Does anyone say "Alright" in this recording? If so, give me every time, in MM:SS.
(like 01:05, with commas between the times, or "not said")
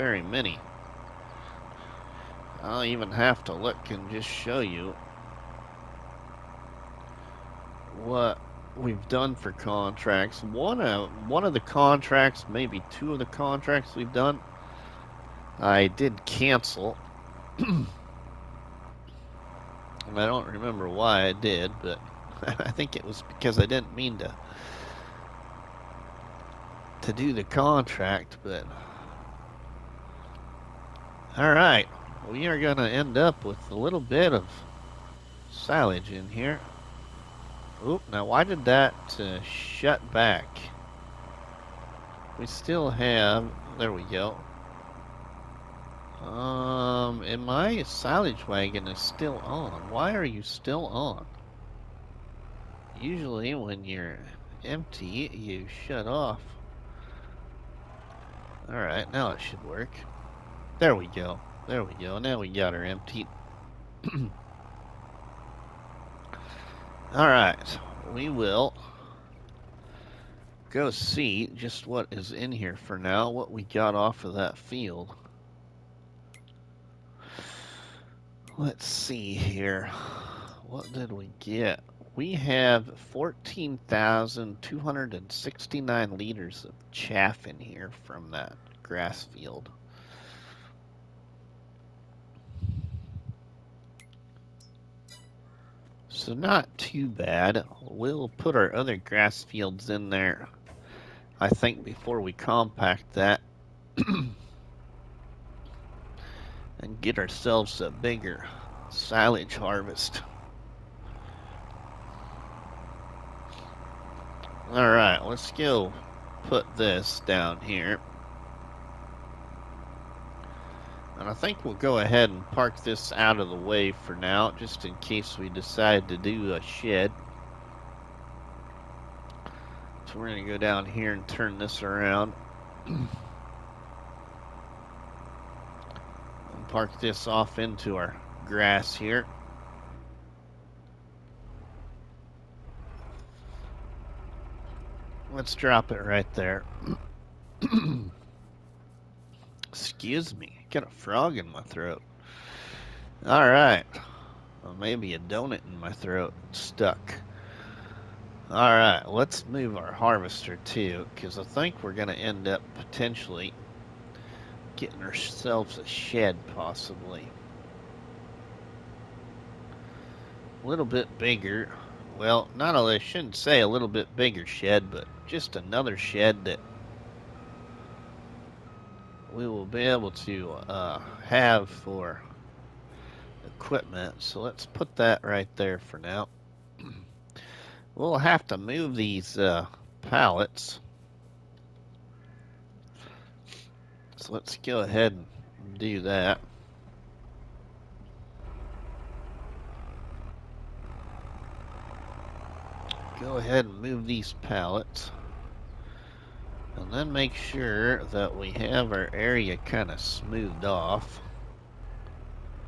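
00:58, 01:07, 01:54.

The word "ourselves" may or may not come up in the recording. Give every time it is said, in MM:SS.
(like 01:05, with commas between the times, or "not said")
01:47, 02:45.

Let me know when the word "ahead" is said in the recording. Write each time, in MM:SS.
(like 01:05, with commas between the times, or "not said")
02:01, 03:14, 03:23.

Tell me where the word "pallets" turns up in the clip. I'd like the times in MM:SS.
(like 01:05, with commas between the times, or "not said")
03:10, 03:24.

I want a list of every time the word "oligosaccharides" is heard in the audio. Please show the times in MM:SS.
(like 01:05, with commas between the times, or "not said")
not said.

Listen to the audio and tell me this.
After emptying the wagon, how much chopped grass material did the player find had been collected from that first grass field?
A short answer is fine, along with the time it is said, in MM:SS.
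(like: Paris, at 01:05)
14,269 liters, at 01:23.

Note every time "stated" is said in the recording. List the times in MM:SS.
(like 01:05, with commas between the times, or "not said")
not said.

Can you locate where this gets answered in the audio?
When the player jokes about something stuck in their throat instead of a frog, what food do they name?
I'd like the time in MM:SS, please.
02:35.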